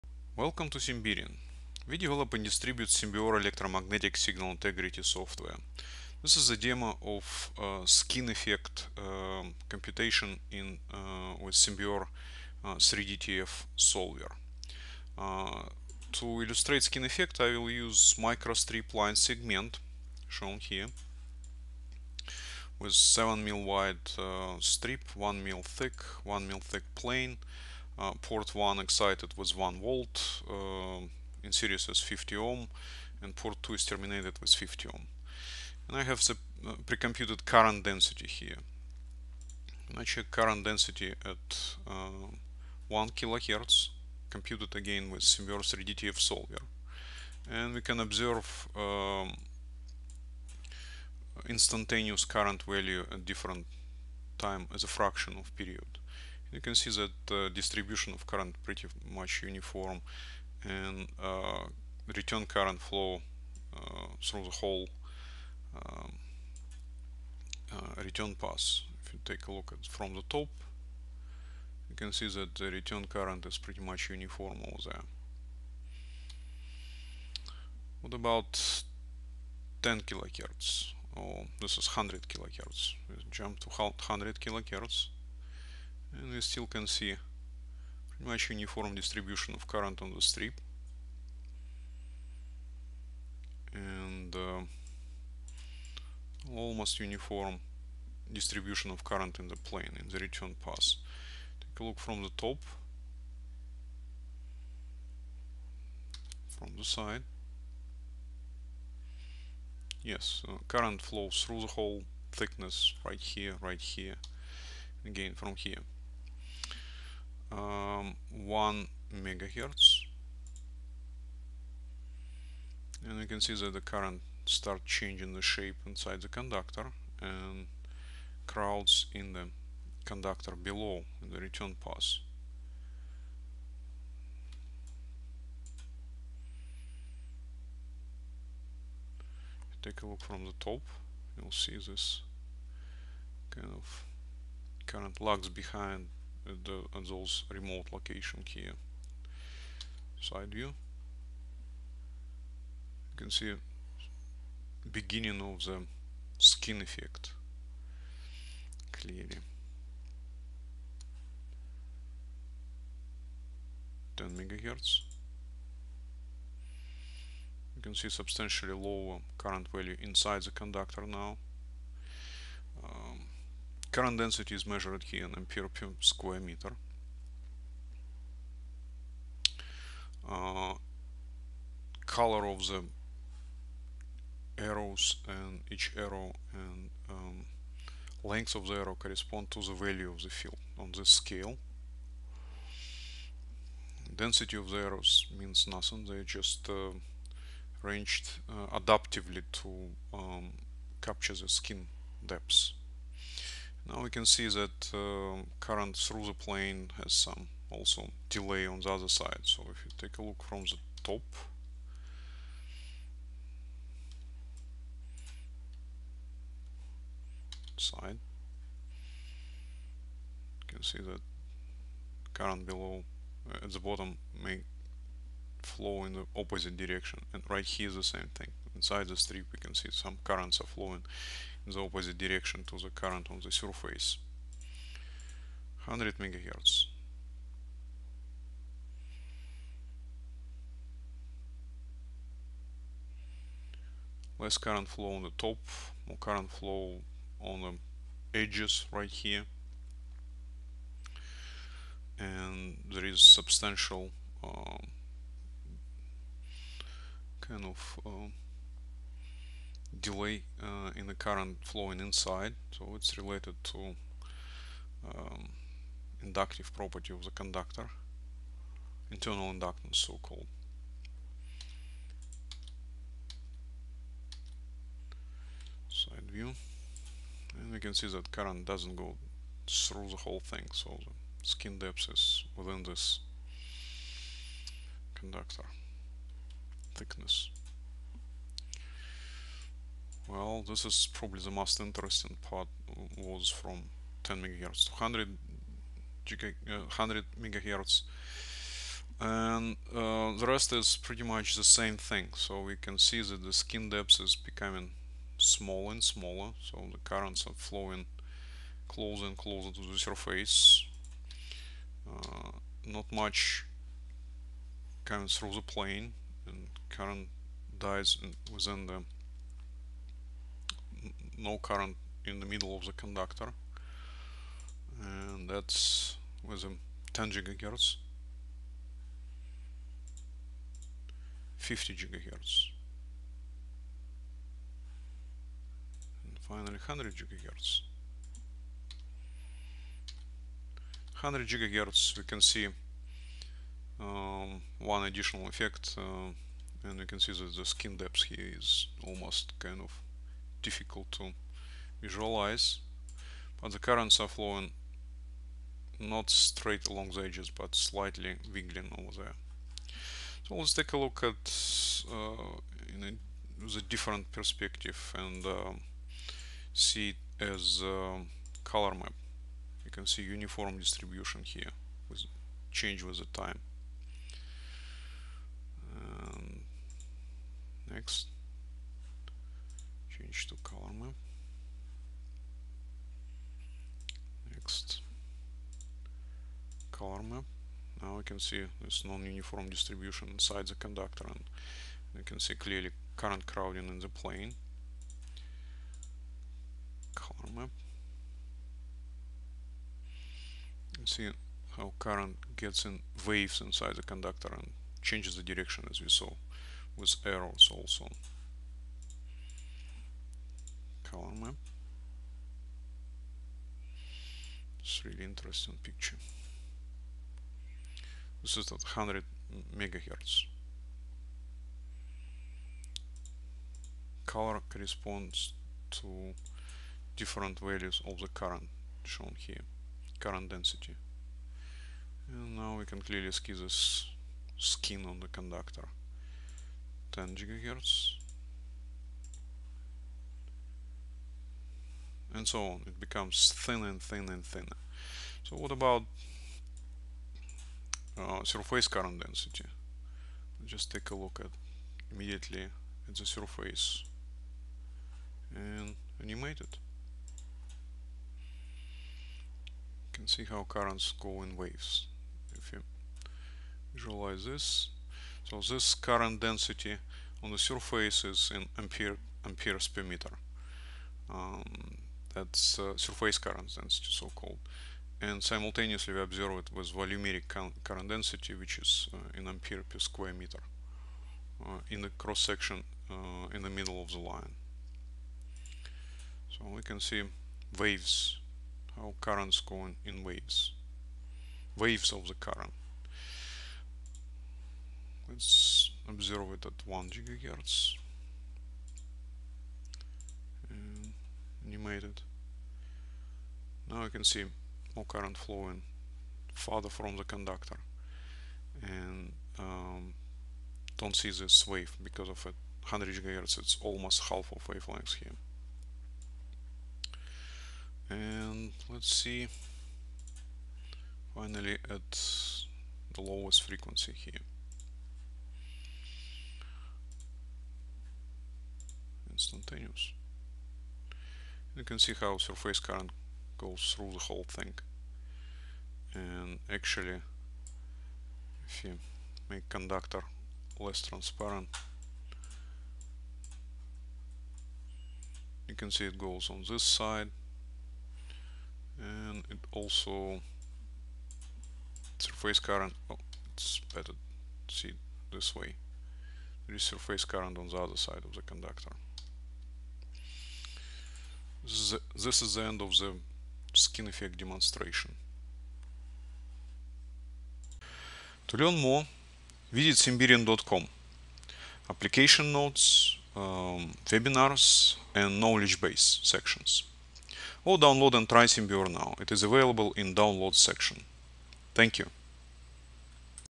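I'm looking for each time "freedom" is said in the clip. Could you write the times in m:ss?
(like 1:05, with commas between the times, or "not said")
not said.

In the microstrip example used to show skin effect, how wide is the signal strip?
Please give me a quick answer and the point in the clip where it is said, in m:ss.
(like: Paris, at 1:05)
7 mil, at 0:22.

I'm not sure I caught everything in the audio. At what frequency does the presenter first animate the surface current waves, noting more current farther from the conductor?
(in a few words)
1 gigahertz.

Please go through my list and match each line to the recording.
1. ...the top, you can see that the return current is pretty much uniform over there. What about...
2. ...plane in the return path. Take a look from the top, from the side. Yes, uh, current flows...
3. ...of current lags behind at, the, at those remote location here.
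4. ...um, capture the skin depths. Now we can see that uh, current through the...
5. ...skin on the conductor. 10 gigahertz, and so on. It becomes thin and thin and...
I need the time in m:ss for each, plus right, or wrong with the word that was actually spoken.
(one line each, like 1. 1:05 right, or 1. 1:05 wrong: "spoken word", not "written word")
1. 1:10 right
2. 1:39 right
3. 2:23 right
4. 3:20 right
5. 7:14 right.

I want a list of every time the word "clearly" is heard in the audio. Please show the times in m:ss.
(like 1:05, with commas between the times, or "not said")
2:38, 6:32, 7:13.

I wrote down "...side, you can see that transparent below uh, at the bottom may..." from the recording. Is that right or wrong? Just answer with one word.
wrong.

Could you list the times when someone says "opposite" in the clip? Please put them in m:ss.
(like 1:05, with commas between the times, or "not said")
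3:46, 3:51.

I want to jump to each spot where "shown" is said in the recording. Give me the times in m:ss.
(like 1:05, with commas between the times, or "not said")
0:20, 7:09.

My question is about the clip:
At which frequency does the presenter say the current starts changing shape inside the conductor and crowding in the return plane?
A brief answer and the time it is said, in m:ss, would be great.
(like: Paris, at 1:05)
1 megahertz, at 1:58.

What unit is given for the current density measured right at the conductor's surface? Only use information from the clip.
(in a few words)
amperes per meter.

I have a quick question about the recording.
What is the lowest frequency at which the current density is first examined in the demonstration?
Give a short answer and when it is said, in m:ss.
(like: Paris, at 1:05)
1 kilohertz, at 0:42.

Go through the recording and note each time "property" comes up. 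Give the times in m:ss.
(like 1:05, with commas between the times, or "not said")
4:26.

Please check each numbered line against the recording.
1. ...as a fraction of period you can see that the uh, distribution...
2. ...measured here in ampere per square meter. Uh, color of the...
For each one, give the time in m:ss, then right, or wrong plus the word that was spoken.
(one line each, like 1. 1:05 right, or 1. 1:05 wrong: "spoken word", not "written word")
1. 0:54 right
2. 2:54 right.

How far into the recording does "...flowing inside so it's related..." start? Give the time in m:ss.
4:21.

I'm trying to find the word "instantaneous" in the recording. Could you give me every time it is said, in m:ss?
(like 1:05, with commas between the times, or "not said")
0:51, 8:49.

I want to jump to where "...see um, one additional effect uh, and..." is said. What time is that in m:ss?
5:42.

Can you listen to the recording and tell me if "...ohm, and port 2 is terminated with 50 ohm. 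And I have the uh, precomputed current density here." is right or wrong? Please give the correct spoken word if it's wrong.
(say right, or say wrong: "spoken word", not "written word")
right.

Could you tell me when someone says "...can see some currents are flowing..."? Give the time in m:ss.
3:49.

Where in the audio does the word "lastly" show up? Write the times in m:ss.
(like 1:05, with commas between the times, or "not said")
not said.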